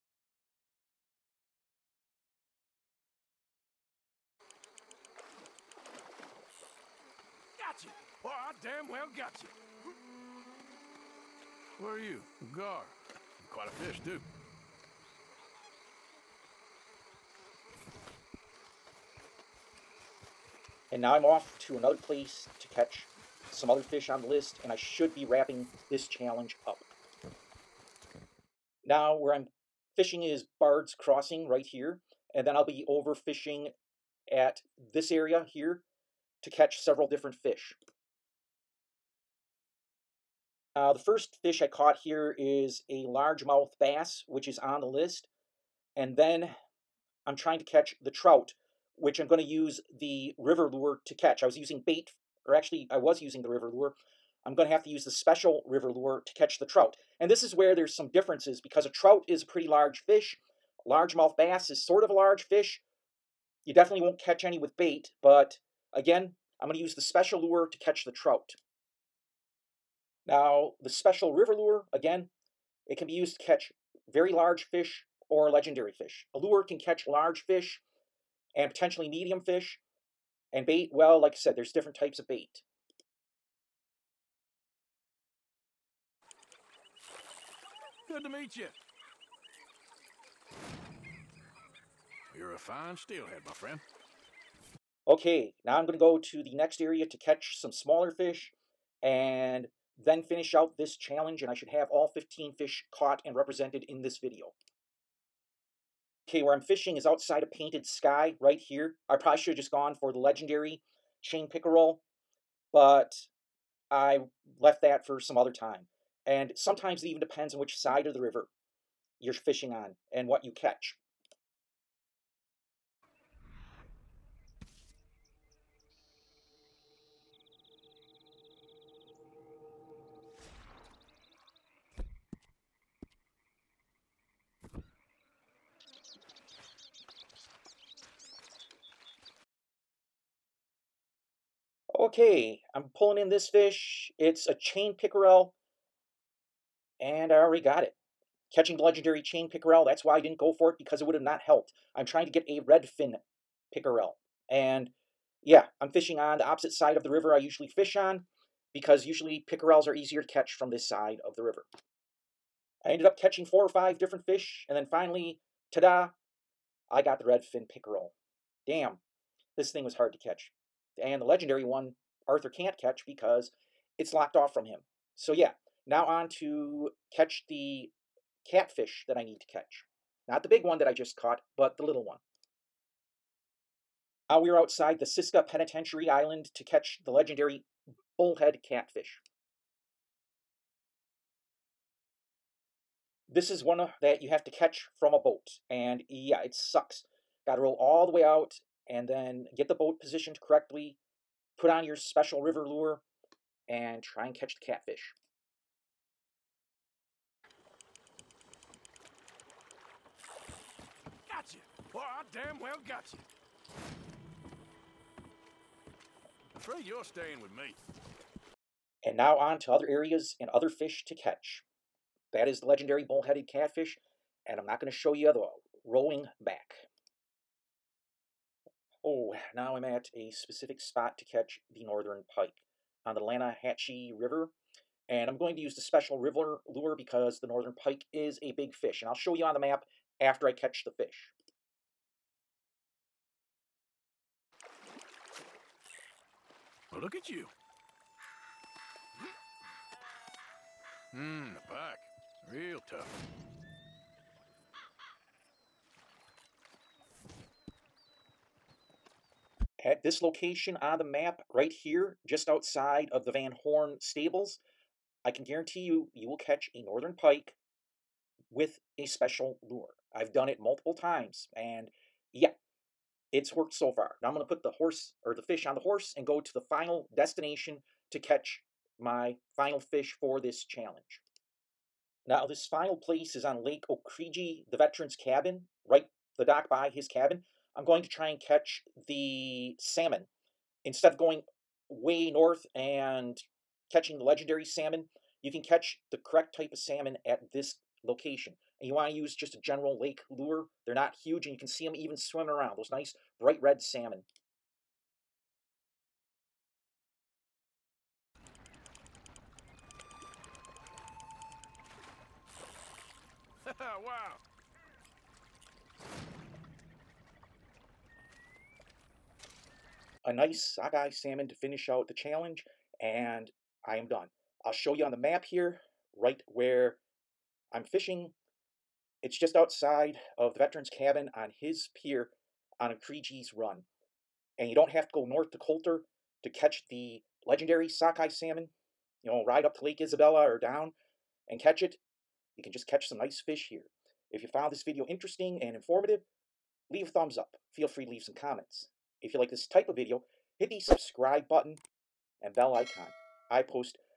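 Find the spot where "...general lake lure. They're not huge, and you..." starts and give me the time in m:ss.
4:59.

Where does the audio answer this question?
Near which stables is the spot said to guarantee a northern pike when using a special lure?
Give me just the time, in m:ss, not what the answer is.
4:23.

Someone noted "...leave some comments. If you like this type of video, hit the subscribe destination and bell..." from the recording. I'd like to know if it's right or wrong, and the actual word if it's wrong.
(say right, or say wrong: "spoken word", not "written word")
wrong: "button", not "destination".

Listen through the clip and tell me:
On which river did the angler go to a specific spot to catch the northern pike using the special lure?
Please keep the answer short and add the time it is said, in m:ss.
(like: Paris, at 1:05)
Lannahechee River, at 3:53.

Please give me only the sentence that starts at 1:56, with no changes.
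And sometimes it even depends on which side of the river you're fishing on and what you catch.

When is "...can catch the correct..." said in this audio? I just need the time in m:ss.
4:55.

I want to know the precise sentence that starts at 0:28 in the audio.
Now where I'm fishing is Bard's Crossing right here.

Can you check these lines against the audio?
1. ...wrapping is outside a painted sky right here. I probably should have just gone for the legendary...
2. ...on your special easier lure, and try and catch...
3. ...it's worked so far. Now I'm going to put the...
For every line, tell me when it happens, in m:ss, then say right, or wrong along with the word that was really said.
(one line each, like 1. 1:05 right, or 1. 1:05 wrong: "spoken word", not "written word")
1. 1:46 wrong: "fishing", not "wrapping"
2. 3:21 wrong: "river", not "easier"
3. 4:33 right.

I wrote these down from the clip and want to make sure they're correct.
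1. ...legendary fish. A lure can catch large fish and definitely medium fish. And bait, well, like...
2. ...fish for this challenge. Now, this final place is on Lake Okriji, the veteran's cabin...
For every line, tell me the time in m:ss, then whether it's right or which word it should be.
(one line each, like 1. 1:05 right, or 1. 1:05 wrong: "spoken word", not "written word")
1. 1:15 wrong: "potentially", not "definitely"
2. 4:39 right.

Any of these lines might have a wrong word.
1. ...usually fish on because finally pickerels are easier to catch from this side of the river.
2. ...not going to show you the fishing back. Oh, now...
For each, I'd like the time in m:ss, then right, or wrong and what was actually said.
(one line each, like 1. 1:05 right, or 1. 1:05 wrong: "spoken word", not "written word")
1. 2:37 wrong: "usually", not "finally"
2. 3:44 wrong: "rolling", not "fishing".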